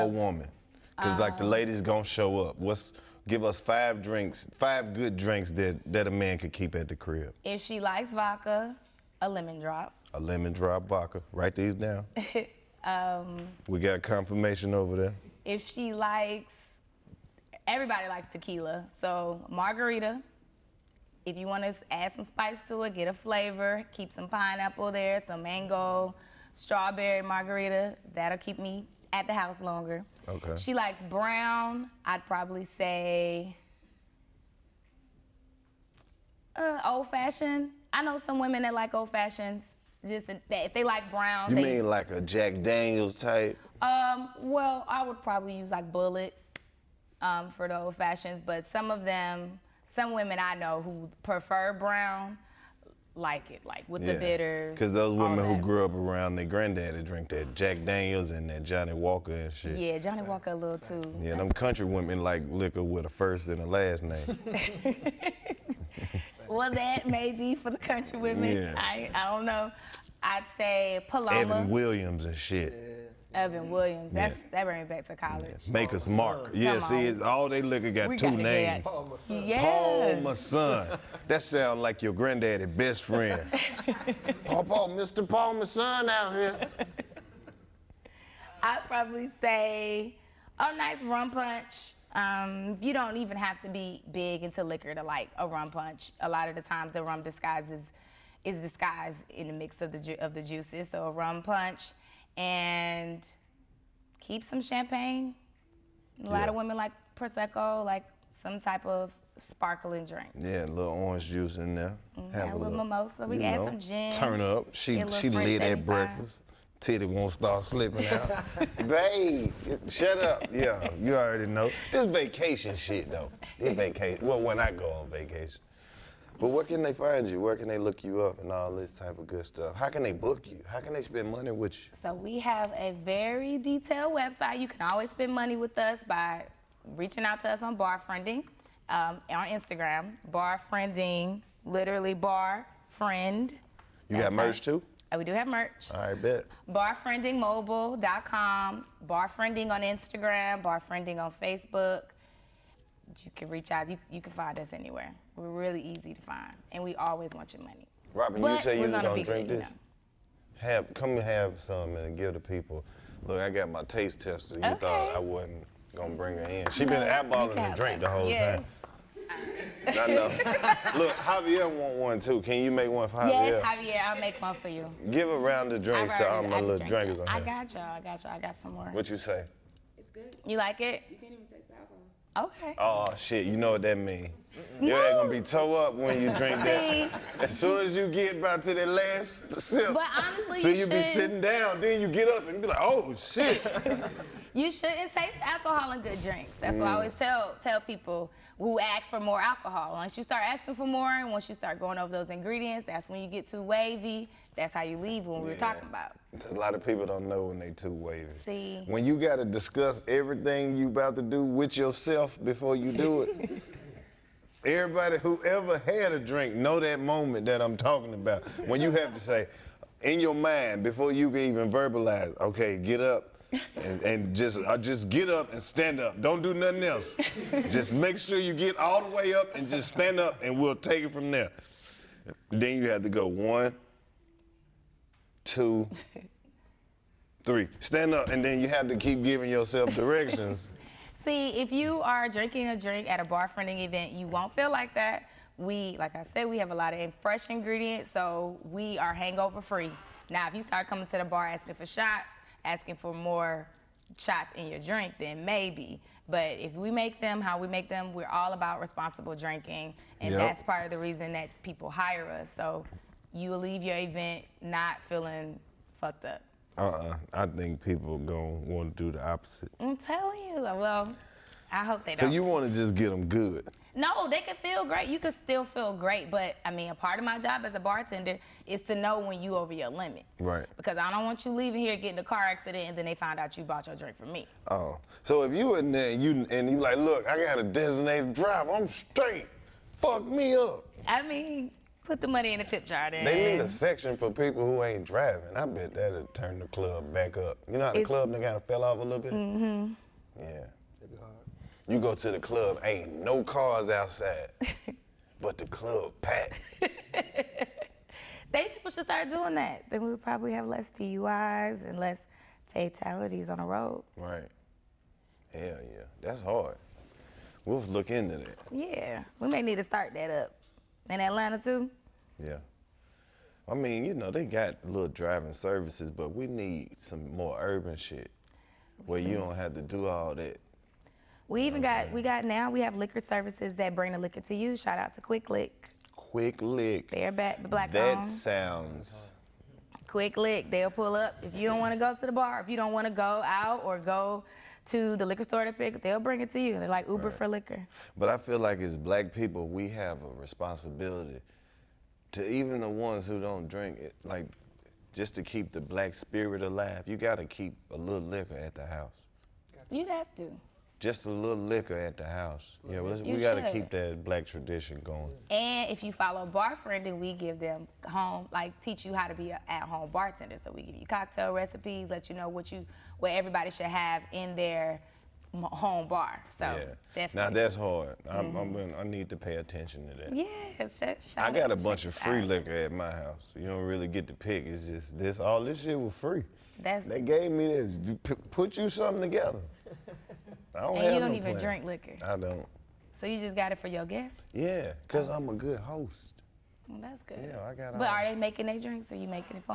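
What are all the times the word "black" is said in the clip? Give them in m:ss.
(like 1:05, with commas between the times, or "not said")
5:37, 5:48, 5:55, 6:04.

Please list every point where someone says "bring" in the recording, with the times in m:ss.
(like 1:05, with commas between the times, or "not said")
1:14, 2:46, 5:33, 5:46.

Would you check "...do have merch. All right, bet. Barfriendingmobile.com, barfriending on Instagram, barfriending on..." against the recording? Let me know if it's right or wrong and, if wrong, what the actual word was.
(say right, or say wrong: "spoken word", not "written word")
right.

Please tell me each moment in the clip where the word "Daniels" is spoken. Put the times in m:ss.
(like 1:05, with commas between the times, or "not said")
0:42, 0:57.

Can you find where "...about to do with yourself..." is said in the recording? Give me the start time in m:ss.
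3:30.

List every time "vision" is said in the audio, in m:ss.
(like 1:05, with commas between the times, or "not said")
not said.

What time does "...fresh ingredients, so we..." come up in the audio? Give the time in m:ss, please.
4:07.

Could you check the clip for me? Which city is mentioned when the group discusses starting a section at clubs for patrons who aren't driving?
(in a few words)
Atlanta.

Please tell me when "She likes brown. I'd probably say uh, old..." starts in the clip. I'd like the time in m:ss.
0:30.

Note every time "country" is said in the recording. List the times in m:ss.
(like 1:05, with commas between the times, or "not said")
1:01, 1:07.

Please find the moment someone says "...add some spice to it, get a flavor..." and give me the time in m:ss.
0:21.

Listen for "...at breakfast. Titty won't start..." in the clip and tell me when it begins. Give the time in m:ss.
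1:55.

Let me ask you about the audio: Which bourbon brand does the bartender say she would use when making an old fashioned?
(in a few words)
Bulleit.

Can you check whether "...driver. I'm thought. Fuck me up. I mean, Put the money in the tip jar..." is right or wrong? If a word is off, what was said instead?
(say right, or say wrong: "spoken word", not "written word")
wrong: "straight", not "thought".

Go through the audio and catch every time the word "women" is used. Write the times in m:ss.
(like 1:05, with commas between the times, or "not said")
0:38, 0:50, 0:55, 1:01, 1:08, 1:46.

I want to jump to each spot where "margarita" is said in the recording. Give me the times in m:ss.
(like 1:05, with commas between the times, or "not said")
0:19, 0:27.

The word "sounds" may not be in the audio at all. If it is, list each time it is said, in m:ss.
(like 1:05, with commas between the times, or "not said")
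1:21, 5:38.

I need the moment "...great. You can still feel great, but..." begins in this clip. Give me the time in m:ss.
4:34.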